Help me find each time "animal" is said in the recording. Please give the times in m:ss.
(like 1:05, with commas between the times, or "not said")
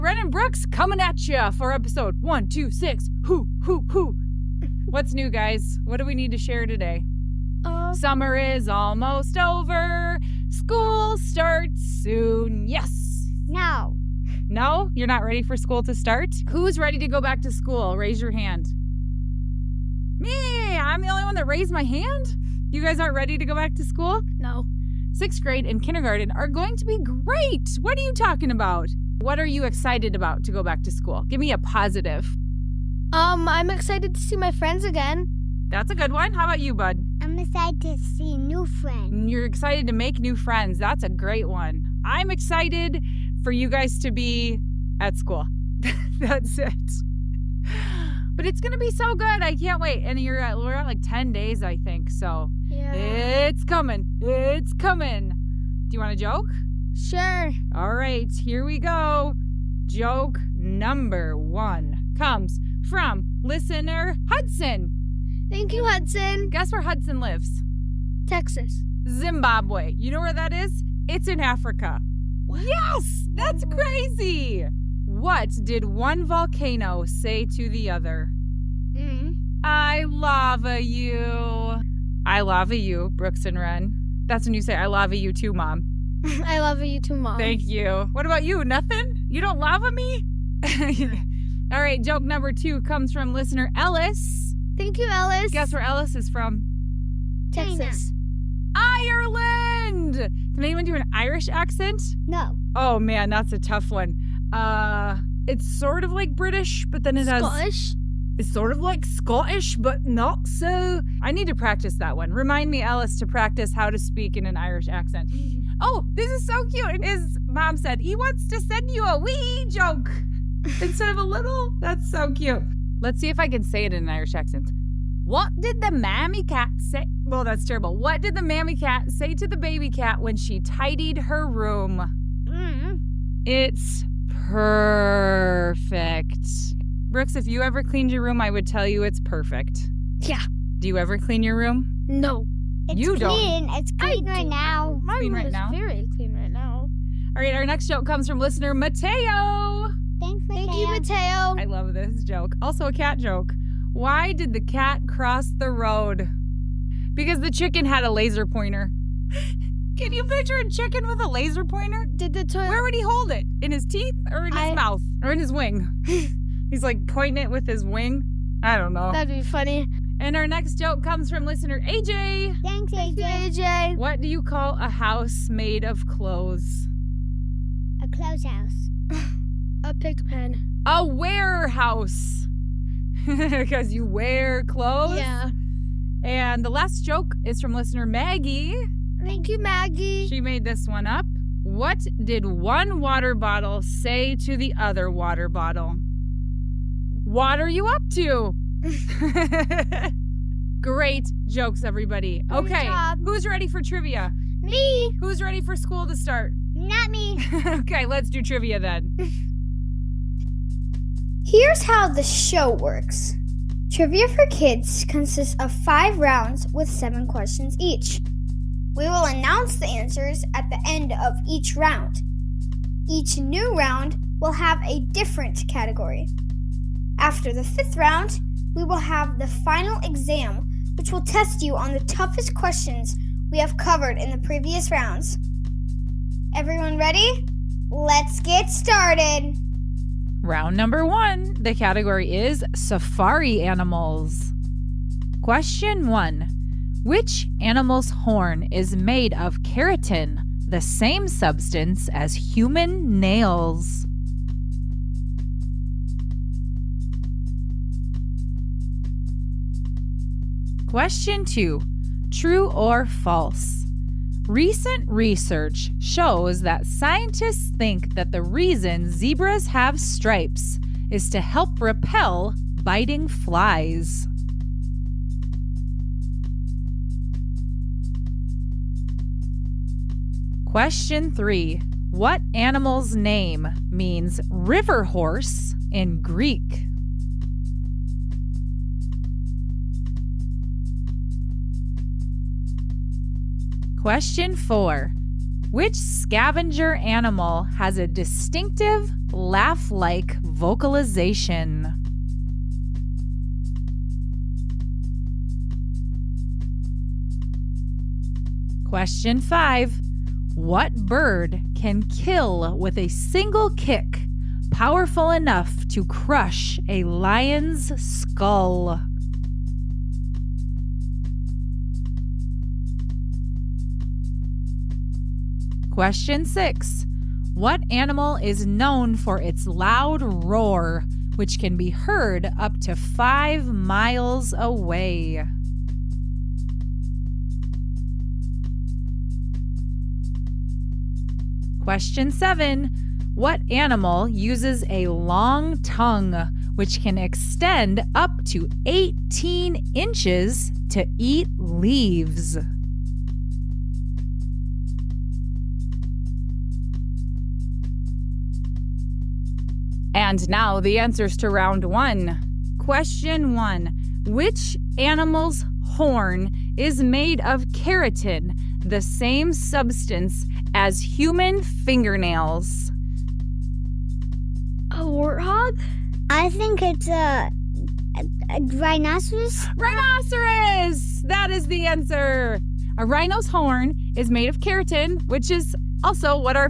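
4:03, 4:07, 4:42, 4:56, 5:27, 5:43, 6:04.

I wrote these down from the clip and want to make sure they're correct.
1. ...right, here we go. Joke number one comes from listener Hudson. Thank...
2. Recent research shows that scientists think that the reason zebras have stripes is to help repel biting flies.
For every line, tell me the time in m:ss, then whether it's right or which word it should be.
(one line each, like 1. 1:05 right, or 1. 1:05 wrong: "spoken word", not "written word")
1. 0:57 right
2. 4:24 right.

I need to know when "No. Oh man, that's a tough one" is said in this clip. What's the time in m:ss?
1:42.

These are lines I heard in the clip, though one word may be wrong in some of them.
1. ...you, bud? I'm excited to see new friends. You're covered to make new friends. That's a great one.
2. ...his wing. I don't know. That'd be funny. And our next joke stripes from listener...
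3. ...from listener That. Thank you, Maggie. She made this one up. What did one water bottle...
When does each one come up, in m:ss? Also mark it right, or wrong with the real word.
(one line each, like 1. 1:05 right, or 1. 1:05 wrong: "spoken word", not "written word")
1. 0:36 wrong: "excited", not "covered"
2. 2:47 wrong: "comes", not "stripes"
3. 3:07 wrong: "Maggie", not "That".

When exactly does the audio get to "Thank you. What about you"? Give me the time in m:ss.
1:27.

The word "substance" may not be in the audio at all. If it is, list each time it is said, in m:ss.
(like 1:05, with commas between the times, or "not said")
4:11, 6:09.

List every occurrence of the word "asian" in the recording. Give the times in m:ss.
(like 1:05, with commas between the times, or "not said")
not said.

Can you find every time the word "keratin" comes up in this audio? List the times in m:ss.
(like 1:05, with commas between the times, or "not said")
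4:09, 6:07, 6:24.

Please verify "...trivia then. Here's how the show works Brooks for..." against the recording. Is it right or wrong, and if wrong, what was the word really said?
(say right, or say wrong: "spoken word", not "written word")
wrong: "Trivia", not "Brooks".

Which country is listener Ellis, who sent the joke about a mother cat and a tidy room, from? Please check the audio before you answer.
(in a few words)
Ireland.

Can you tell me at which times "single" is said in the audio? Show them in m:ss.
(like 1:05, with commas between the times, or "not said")
5:13.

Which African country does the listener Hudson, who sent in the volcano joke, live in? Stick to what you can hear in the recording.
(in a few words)
Zimbabwe.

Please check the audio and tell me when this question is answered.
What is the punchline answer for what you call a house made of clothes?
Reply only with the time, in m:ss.
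3:00.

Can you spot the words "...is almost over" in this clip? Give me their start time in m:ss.
0:08.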